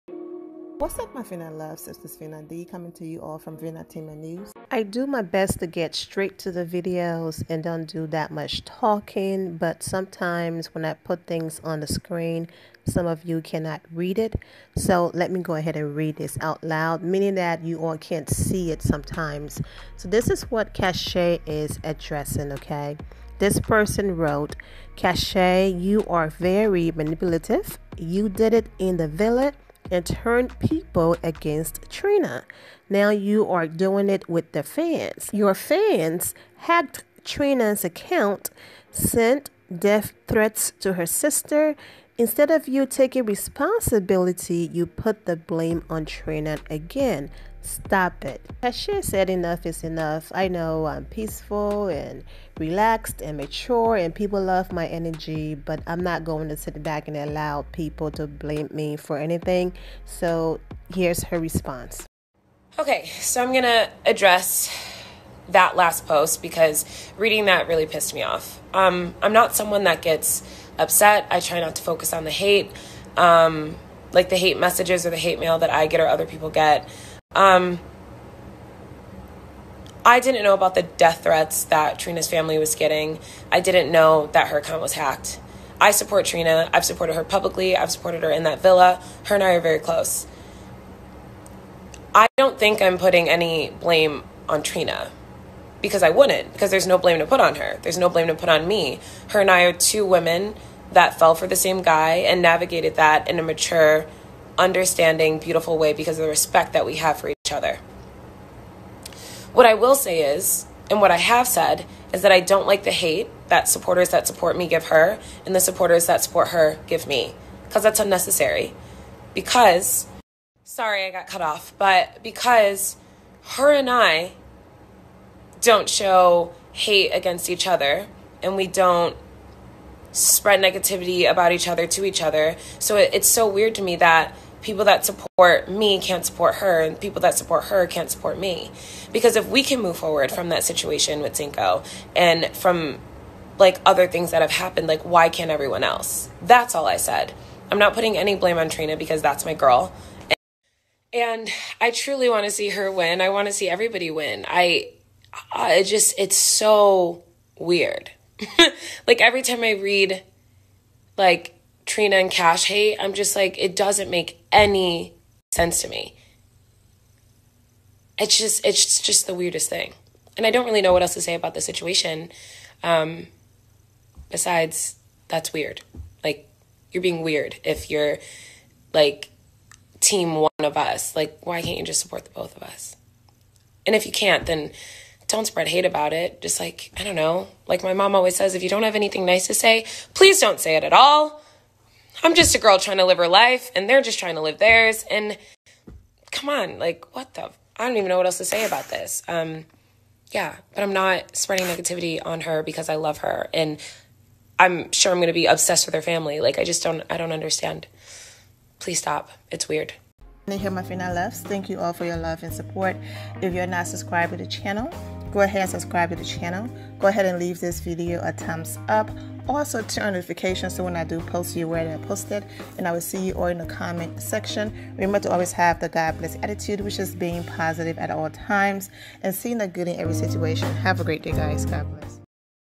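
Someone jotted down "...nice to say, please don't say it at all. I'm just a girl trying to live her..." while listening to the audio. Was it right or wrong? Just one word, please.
right.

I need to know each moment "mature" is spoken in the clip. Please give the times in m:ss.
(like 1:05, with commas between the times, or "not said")
0:53, 1:43.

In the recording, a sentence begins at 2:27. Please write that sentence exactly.
I'm not putting any blame on Trina because that's my girl.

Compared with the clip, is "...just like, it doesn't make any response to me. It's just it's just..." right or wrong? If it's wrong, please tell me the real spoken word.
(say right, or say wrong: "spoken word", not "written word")
wrong: "sense", not "response".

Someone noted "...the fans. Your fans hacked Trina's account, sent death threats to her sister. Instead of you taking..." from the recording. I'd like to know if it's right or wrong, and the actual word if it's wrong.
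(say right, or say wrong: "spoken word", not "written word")
right.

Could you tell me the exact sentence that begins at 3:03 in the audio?
And if you can't, then don't spread hate about it.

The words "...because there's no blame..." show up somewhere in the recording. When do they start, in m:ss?
1:36.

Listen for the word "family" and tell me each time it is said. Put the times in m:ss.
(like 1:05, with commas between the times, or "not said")
1:22, 3:26.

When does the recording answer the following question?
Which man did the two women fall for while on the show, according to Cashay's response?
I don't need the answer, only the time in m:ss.
2:21.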